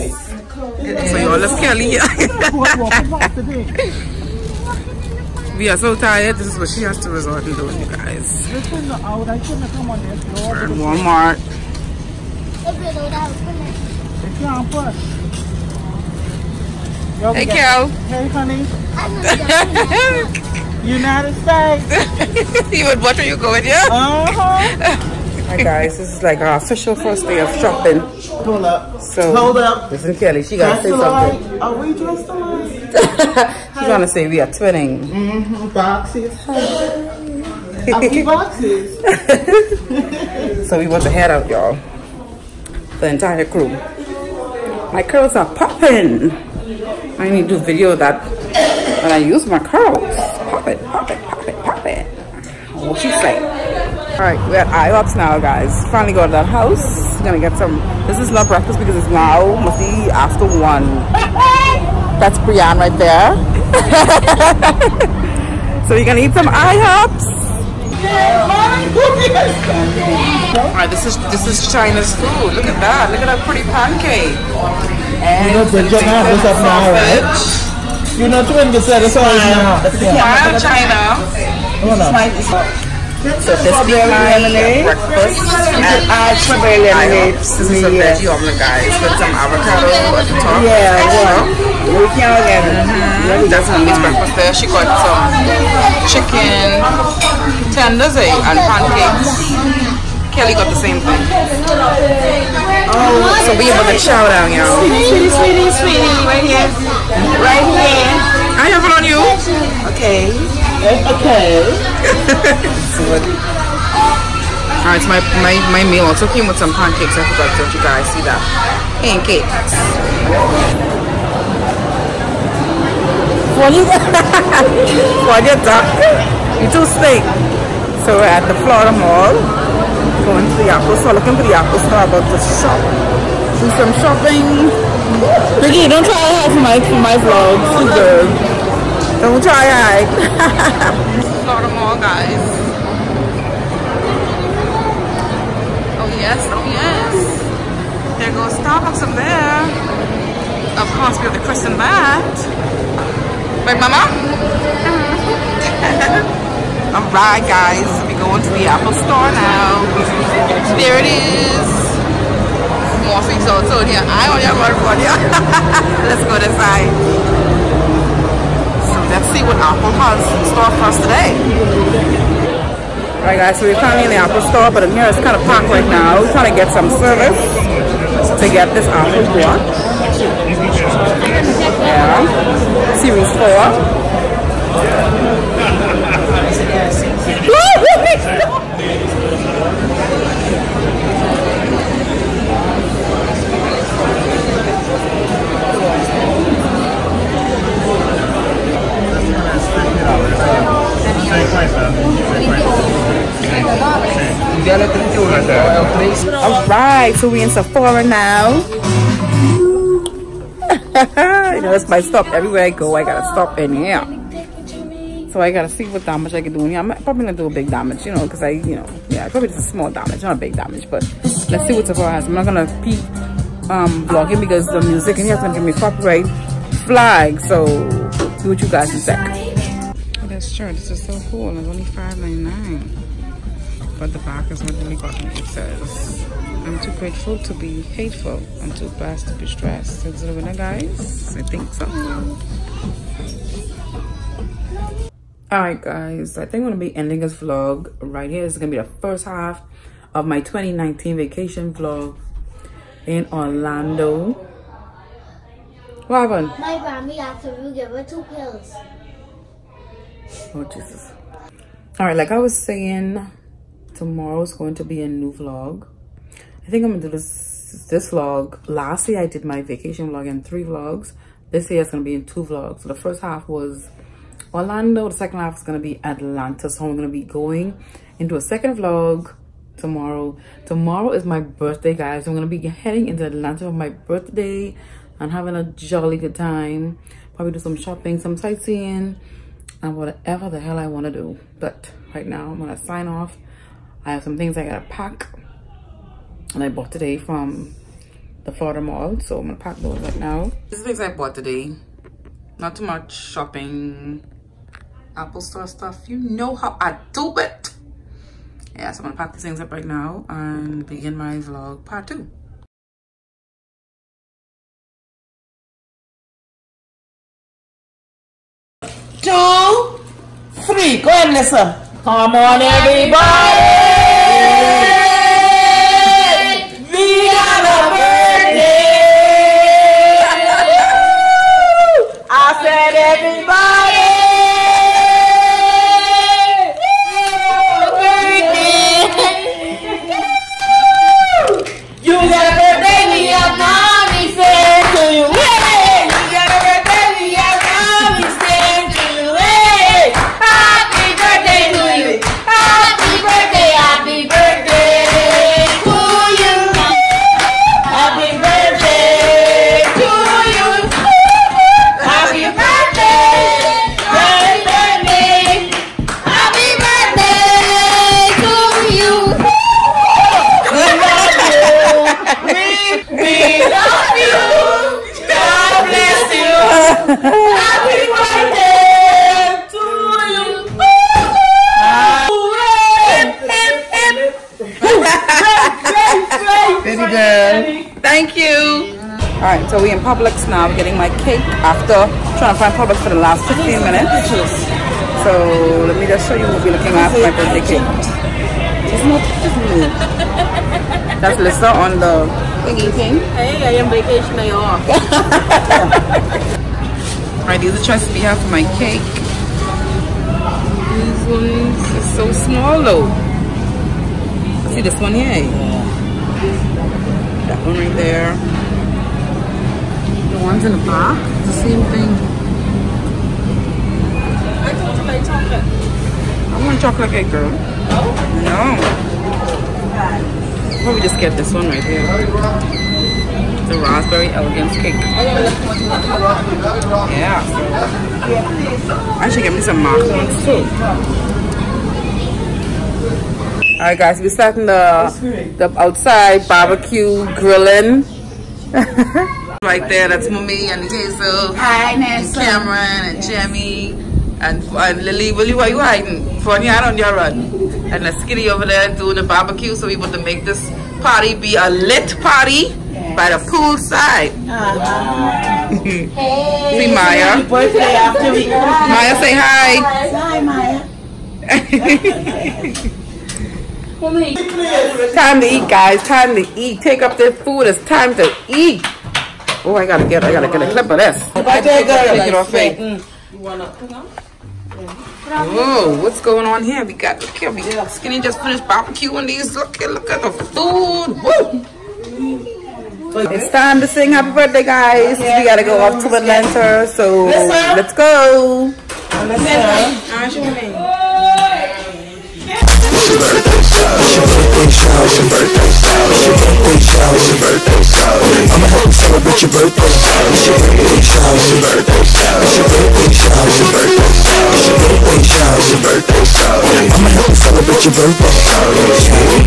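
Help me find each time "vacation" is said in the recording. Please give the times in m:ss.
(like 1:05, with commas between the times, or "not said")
4:11, 4:29, 6:43.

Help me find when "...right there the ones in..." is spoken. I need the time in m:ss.
6:57.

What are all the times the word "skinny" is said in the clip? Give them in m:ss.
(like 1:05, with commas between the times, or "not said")
7:38, 8:07.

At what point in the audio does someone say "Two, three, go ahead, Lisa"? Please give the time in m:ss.
5:19.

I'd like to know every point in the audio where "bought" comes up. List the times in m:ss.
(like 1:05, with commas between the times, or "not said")
4:56, 5:01.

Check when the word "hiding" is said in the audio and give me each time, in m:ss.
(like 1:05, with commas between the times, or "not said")
7:35.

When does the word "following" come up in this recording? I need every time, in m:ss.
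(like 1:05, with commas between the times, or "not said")
not said.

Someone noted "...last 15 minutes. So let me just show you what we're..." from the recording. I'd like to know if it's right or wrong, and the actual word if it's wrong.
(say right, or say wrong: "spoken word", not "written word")
right.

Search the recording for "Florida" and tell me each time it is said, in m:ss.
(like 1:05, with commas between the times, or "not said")
2:08, 4:58.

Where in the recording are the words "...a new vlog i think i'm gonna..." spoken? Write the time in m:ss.
4:25.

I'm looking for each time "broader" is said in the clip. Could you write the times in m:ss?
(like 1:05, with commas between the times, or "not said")
not said.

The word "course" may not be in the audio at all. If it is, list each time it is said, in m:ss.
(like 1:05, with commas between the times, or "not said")
2:31.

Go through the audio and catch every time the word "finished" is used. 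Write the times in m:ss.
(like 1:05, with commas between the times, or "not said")
8:08.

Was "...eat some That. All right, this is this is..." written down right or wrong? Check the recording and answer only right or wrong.
wrong.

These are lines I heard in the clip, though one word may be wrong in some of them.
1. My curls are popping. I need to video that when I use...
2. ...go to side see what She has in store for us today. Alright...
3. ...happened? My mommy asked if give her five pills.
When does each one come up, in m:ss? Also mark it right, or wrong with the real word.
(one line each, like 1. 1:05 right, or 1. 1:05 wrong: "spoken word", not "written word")
1. 0:44 right
2. 2:46 wrong: "Apple", not "She"
3. 4:16 wrong: "two", not "five".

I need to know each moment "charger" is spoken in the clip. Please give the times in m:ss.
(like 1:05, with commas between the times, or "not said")
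not said.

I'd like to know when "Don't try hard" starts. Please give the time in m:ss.
2:19.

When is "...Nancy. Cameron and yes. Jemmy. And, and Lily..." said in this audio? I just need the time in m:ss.
7:31.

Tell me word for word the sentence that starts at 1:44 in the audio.
Sweetie, sweetie, sweetie, right here, right here.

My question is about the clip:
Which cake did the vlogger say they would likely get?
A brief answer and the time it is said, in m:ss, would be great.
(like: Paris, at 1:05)
Raspberry elegance cake, at 7:13.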